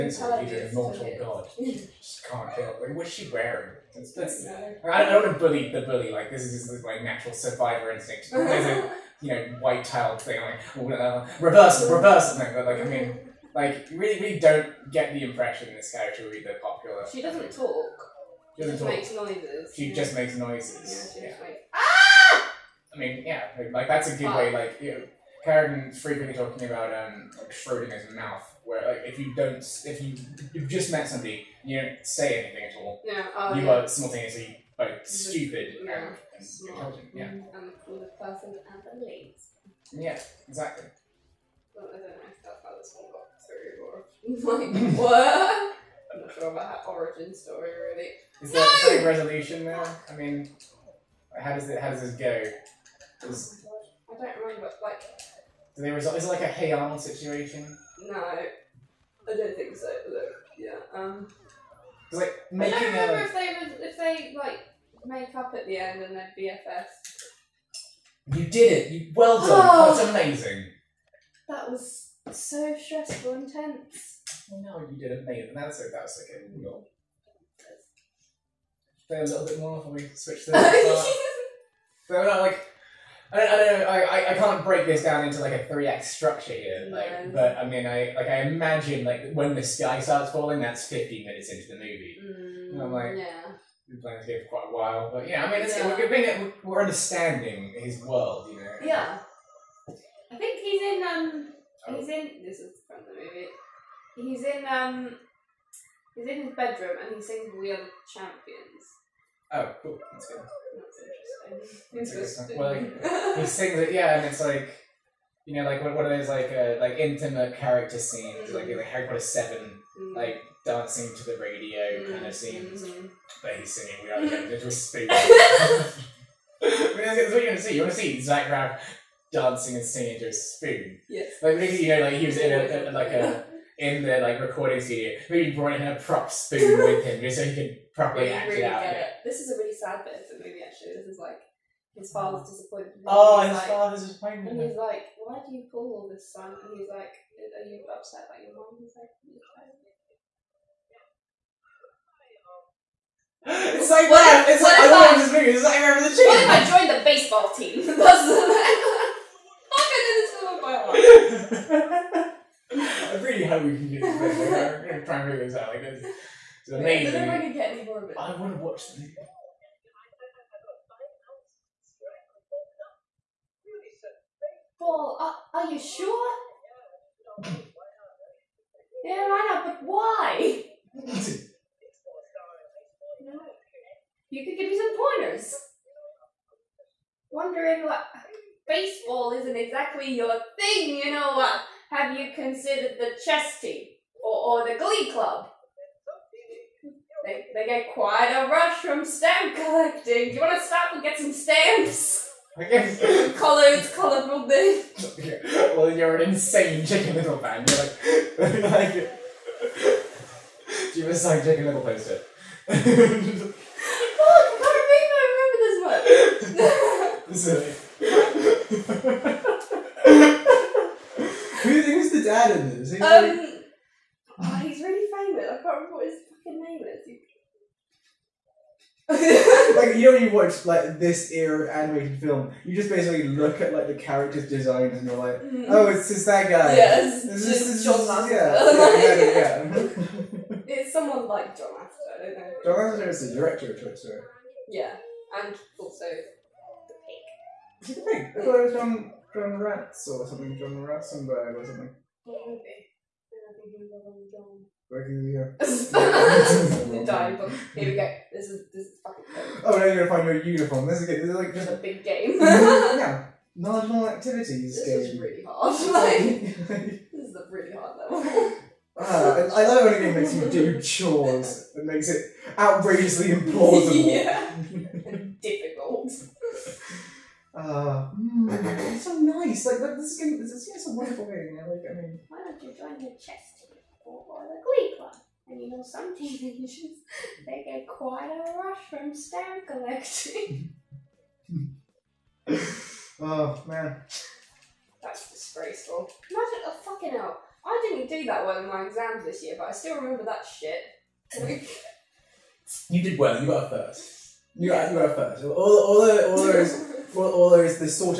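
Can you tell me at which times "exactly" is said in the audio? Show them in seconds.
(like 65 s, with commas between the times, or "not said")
40 s, 189 s.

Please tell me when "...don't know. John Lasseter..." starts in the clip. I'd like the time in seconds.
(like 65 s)
242 s.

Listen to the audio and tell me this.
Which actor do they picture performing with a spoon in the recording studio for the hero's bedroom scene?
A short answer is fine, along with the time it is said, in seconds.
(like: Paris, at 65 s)
Zach Braff, at 128 s.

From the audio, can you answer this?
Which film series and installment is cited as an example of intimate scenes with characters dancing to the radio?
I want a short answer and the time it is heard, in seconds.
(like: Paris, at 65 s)
Harry Potter seven, at 118 s.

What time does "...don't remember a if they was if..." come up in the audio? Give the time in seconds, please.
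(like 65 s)
62 s.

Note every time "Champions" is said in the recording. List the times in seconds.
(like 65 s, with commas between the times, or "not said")
108 s, 124 s.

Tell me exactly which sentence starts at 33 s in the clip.
are simultaneously both like, stupid yeah mm-hmm.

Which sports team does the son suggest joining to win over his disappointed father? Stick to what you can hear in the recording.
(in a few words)
baseball team.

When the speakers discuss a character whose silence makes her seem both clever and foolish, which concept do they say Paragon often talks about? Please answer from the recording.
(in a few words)
Schrodinger's mouth.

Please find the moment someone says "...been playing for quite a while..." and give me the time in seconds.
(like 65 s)
94 s.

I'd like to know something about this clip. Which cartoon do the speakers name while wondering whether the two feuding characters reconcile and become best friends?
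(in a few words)
Hey Arnold.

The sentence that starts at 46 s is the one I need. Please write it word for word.
I'm not sure about that origin story really.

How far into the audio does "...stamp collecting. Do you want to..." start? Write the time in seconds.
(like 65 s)
199 s.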